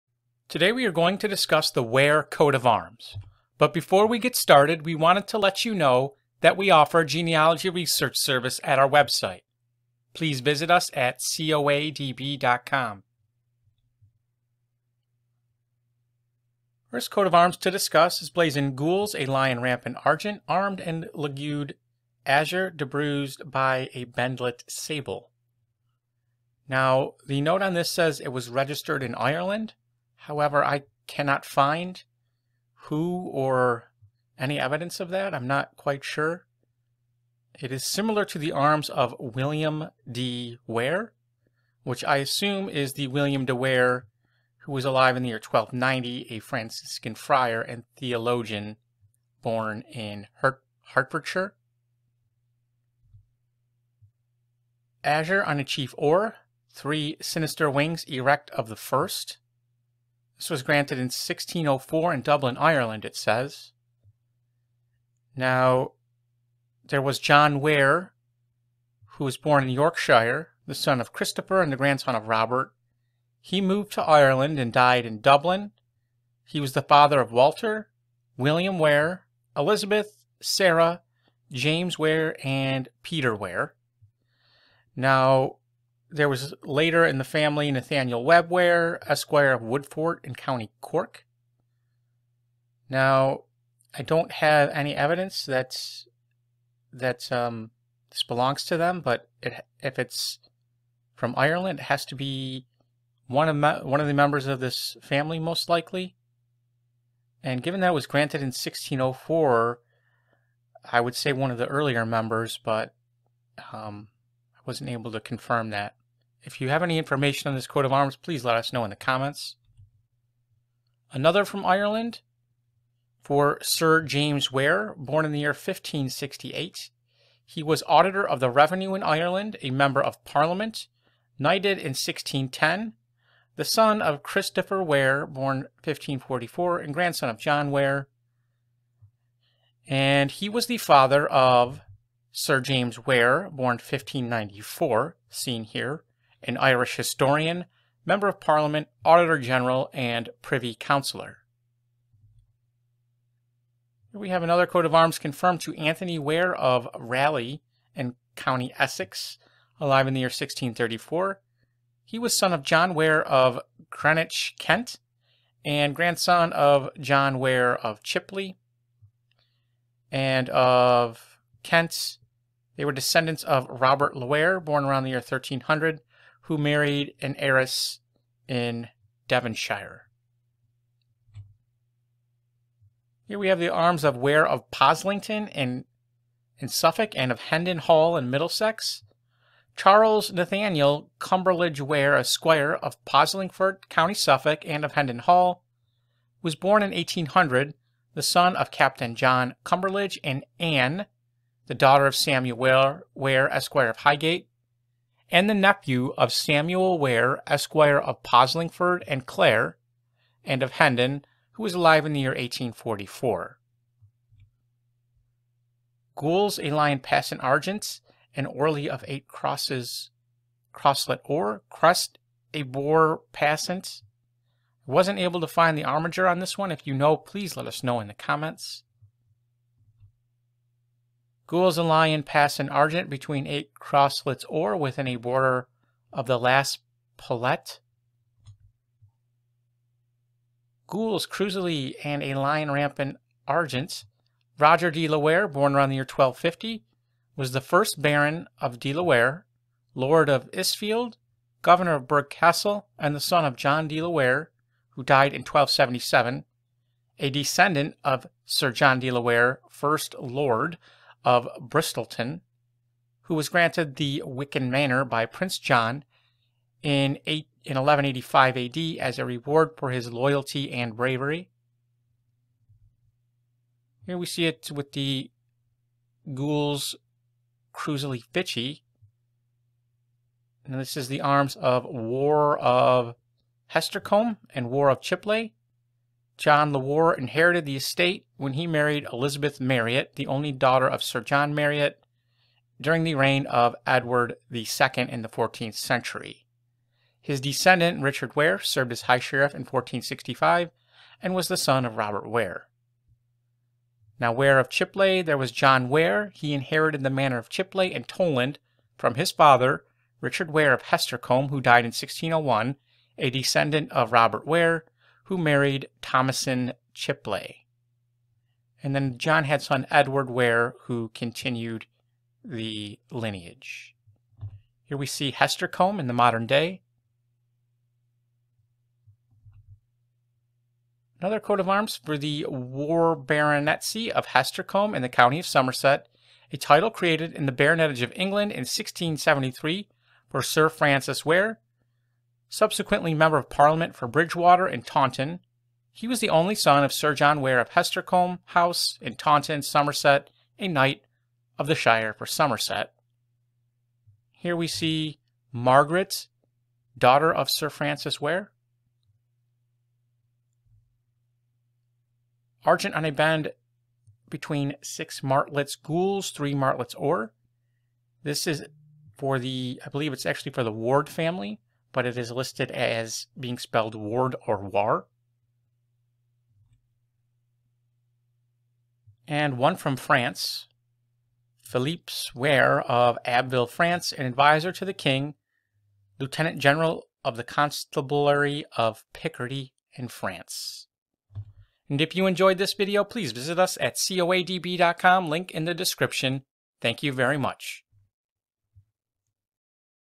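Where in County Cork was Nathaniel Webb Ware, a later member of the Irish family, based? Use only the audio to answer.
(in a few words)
Woodfort.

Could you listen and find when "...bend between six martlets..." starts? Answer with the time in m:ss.
6:03.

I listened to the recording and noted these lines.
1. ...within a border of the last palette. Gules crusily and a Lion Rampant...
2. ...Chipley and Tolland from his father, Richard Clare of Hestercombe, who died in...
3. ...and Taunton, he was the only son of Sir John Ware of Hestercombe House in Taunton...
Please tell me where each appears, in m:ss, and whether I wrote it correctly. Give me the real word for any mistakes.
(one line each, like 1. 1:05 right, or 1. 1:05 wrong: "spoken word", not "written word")
1. 3:54 right
2. 5:07 wrong: "Ware", not "Clare"
3. 5:44 right.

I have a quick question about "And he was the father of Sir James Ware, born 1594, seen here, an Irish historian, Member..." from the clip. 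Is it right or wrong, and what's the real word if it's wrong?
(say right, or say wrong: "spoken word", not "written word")
right.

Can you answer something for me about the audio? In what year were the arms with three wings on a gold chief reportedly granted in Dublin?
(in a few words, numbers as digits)
1604.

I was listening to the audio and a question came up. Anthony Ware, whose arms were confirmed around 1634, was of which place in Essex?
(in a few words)
Rayleigh.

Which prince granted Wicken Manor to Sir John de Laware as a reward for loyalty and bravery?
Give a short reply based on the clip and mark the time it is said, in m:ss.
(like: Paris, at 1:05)
Prince John, at 4:25.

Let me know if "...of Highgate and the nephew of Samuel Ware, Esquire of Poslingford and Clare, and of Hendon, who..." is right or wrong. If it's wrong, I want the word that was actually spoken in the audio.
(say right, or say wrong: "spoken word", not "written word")
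right.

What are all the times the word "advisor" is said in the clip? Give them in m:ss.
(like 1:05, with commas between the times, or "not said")
6:24.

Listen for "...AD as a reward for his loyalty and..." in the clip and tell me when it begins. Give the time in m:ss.
4:28.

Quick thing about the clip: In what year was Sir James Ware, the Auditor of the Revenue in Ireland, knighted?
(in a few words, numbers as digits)
1610.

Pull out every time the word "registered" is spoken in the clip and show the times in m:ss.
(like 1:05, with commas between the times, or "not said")
0:28.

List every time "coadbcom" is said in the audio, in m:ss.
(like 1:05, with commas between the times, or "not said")
0:11, 6:33.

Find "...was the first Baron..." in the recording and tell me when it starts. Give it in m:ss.
4:07.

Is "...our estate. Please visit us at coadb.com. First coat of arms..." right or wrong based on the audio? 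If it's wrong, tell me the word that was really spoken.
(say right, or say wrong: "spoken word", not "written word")
wrong: "website", not "estate".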